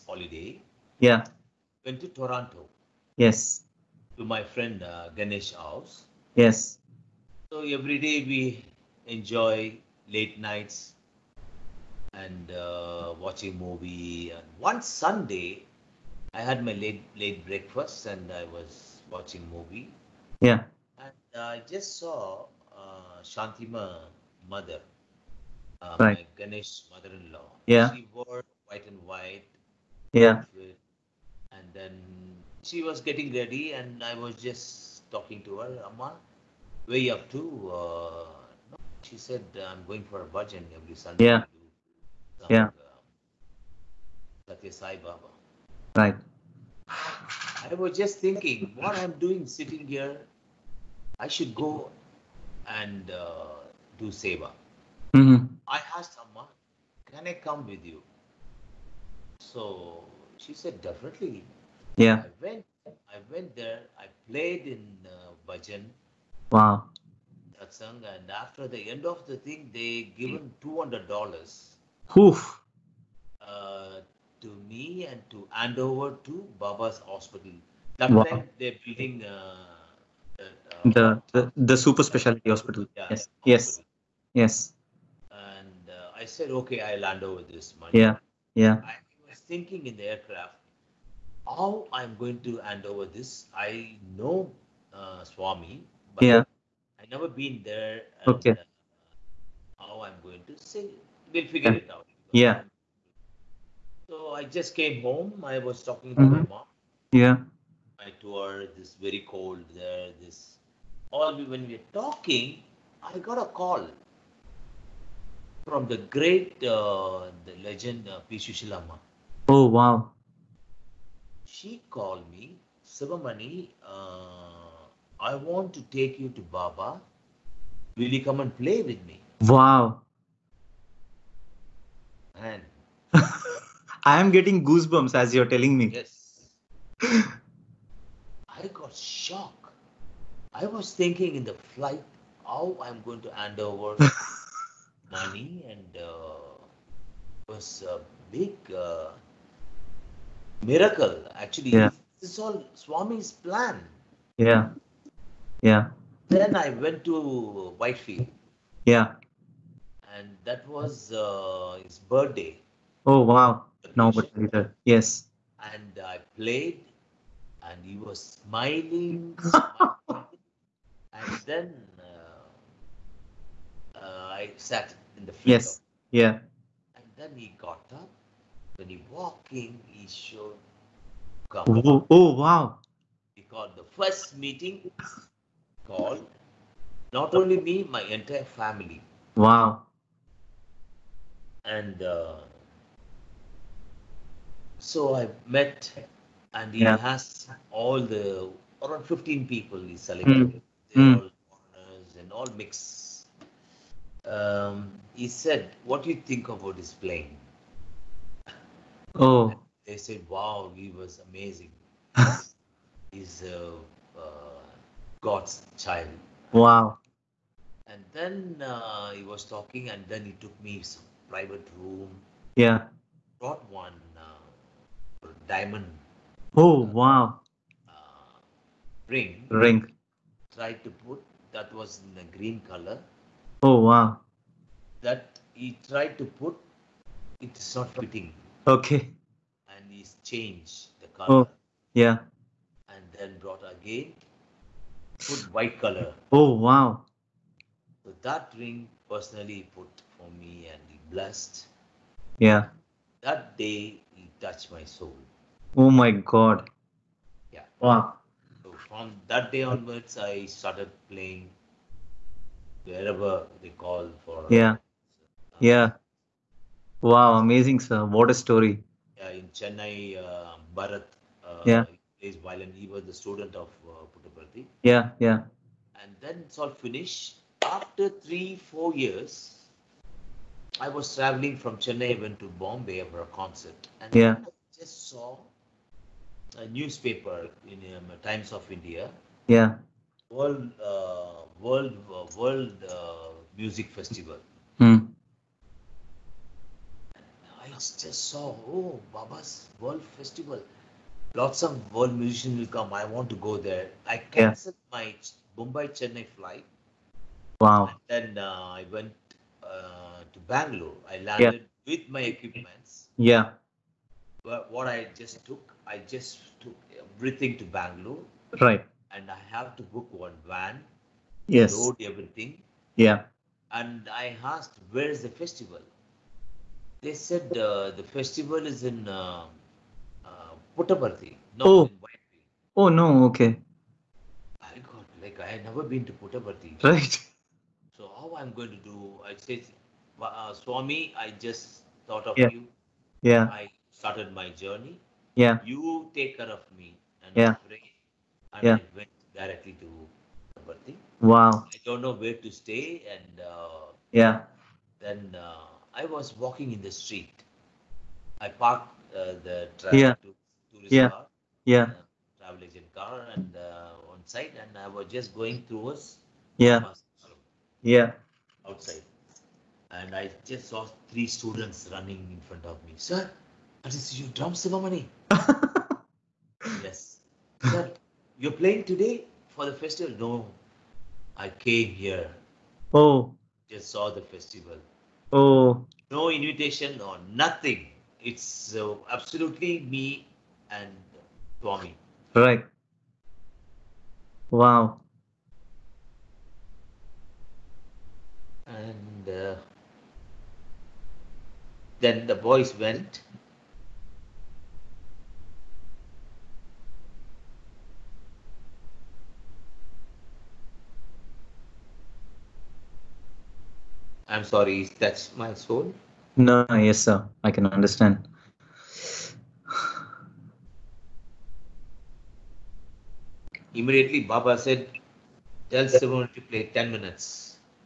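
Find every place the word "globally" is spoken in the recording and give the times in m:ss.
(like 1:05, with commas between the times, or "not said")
not said.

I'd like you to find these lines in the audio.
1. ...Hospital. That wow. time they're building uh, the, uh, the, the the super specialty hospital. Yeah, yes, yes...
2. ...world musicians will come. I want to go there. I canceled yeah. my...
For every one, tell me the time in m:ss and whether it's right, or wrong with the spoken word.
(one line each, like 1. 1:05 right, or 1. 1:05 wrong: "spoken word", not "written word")
1. 1:17 right
2. 5:01 right.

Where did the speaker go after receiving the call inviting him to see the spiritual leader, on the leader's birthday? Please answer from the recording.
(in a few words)
Whitefield.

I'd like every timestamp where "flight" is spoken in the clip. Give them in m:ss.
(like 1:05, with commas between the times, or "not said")
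2:21, 5:06.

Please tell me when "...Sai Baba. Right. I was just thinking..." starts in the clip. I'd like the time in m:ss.
0:44.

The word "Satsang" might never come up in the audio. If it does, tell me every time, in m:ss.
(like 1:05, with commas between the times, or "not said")
1:07.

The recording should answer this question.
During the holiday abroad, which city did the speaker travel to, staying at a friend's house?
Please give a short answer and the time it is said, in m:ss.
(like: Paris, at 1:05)
Toronto, at 0:02.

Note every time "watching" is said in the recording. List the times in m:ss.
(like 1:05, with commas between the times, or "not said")
0:13, 0:19.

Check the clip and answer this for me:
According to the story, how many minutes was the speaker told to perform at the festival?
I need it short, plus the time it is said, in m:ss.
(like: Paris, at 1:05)
10, at 7:06.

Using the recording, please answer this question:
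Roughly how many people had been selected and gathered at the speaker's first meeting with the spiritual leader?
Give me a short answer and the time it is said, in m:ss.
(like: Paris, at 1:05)
15, at 3:19.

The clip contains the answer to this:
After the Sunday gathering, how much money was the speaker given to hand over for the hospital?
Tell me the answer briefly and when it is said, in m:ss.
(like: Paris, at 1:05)
$200, at 1:10.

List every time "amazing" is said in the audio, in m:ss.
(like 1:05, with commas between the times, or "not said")
3:31, 4:27.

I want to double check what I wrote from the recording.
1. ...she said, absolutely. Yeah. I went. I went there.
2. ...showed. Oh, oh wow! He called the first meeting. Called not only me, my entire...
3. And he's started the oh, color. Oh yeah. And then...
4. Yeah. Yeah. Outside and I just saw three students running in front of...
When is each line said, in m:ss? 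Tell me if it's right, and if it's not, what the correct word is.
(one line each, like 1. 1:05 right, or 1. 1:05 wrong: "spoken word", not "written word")
1. 1:00 wrong: "definitely", not "absolutely"
2. 3:00 right
3. 3:59 wrong: "changed", not "started"
4. 6:06 right.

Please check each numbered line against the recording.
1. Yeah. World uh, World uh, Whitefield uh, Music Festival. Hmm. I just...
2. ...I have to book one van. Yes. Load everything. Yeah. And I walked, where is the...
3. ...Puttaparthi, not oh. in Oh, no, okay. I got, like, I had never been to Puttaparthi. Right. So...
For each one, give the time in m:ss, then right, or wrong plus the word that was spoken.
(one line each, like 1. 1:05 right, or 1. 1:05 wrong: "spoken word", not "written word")
1. 4:49 wrong: "World", not "Whitefield"
2. 5:19 wrong: "asked", not "walked"
3. 5:30 right.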